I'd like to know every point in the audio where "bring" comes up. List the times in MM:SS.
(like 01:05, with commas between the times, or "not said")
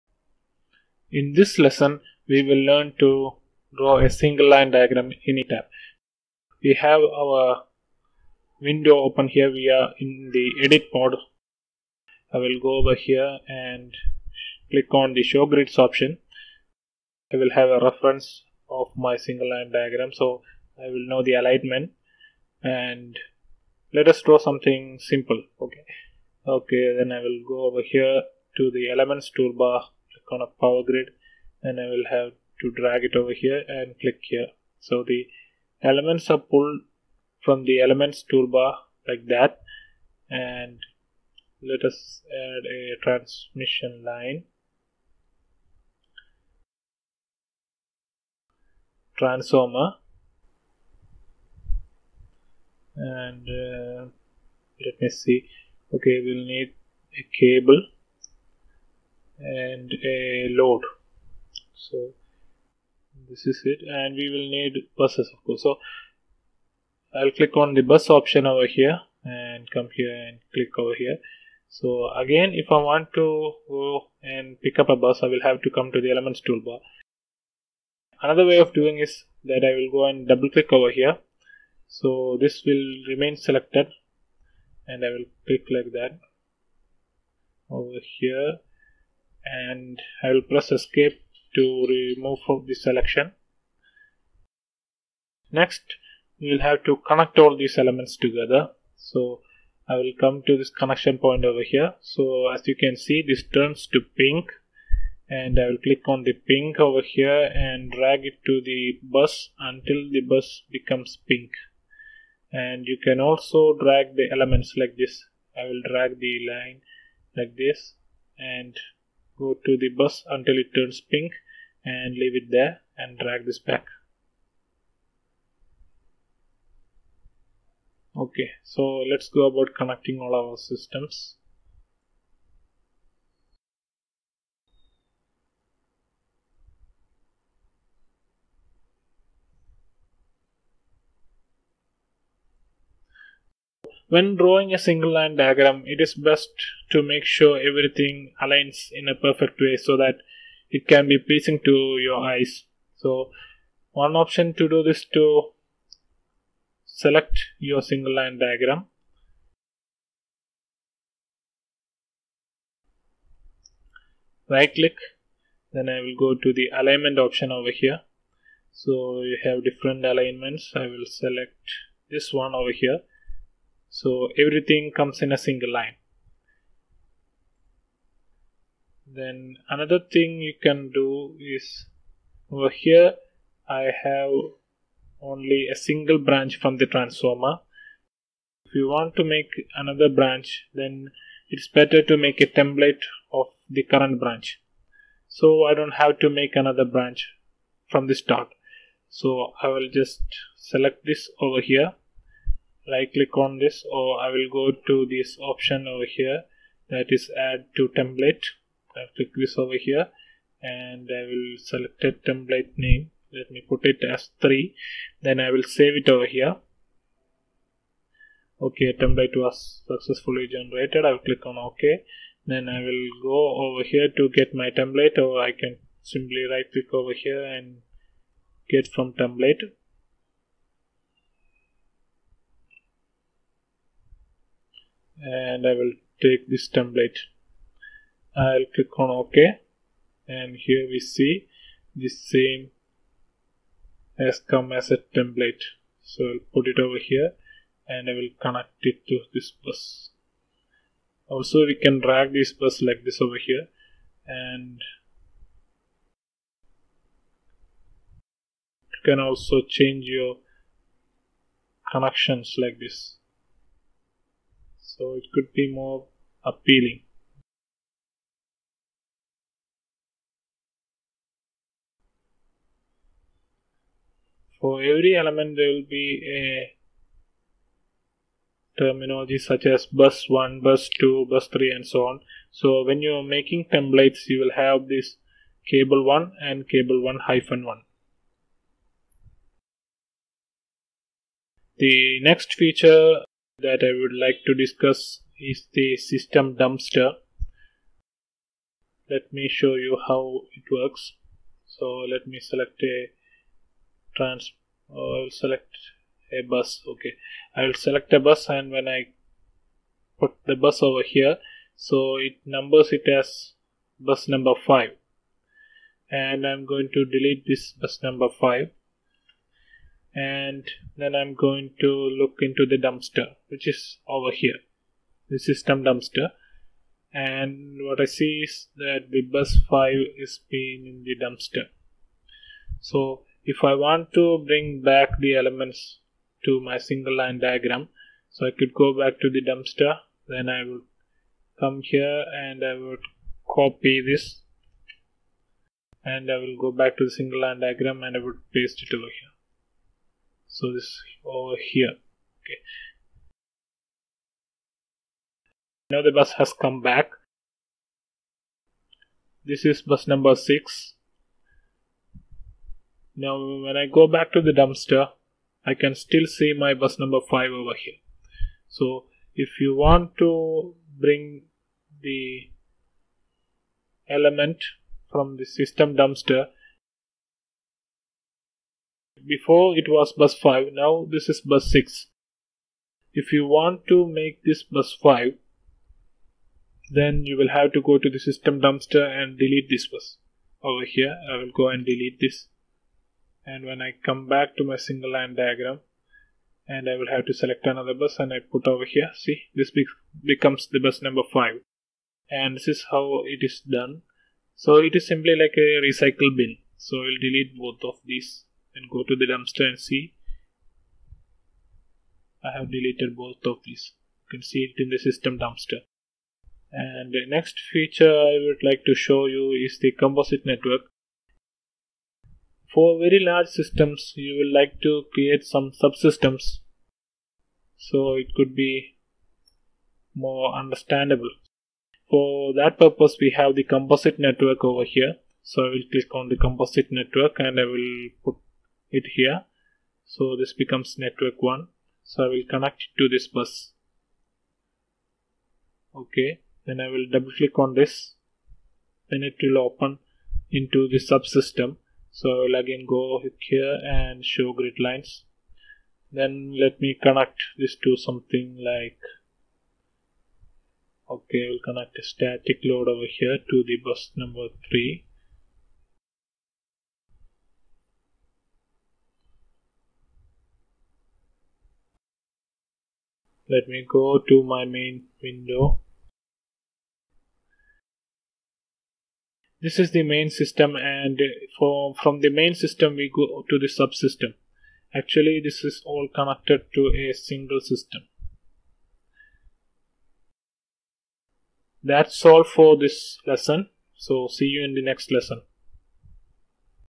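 05:34, 06:11.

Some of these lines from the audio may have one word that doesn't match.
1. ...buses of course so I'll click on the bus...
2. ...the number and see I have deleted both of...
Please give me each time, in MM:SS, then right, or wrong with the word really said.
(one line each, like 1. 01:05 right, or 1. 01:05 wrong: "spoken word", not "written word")
1. 01:04 right
2. 06:49 wrong: "dumpster", not "number".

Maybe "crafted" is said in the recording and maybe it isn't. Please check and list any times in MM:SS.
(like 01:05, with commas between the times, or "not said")
not said.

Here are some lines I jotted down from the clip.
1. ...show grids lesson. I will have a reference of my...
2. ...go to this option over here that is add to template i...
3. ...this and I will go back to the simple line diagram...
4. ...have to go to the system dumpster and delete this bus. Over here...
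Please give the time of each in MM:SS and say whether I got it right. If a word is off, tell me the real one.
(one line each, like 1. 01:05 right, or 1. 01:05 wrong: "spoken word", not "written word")
1. 00:15 wrong: "option", not "lesson"
2. 03:24 right
3. 05:44 wrong: "single", not "simple"
4. 06:27 right.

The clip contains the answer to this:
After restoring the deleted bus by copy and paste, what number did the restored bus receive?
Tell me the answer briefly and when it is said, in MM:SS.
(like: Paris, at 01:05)
6, at 05:59.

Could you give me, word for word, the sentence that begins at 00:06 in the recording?
We have our window open here.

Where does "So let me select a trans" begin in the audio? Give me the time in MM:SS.
05:01.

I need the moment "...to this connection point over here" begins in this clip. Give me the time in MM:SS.
01:40.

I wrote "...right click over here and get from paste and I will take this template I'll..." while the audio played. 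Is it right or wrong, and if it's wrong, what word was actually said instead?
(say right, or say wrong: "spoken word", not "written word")
wrong: "template", not "paste".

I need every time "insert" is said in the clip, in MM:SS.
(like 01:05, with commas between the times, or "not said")
not said.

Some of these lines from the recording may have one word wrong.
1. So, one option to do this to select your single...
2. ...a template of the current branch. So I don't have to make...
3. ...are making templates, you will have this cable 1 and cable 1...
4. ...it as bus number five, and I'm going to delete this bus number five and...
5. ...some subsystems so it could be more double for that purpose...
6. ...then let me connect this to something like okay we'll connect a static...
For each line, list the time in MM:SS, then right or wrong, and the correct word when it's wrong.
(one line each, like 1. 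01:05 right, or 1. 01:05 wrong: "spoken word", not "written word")
1. 02:32 right
2. 03:12 right
3. 04:43 right
4. 05:12 right
5. 07:05 wrong: "understandable", not "double"
6. 07:36 right.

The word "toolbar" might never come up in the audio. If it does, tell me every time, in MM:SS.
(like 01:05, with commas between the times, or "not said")
00:29, 00:38, 01:16.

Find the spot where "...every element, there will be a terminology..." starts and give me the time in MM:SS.
04:34.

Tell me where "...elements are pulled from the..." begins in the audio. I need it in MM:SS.
00:35.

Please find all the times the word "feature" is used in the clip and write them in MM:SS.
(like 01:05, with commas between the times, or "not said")
04:52, 06:57.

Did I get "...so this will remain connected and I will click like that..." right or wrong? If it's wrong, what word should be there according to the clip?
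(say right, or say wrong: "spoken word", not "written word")
wrong: "selected", not "connected".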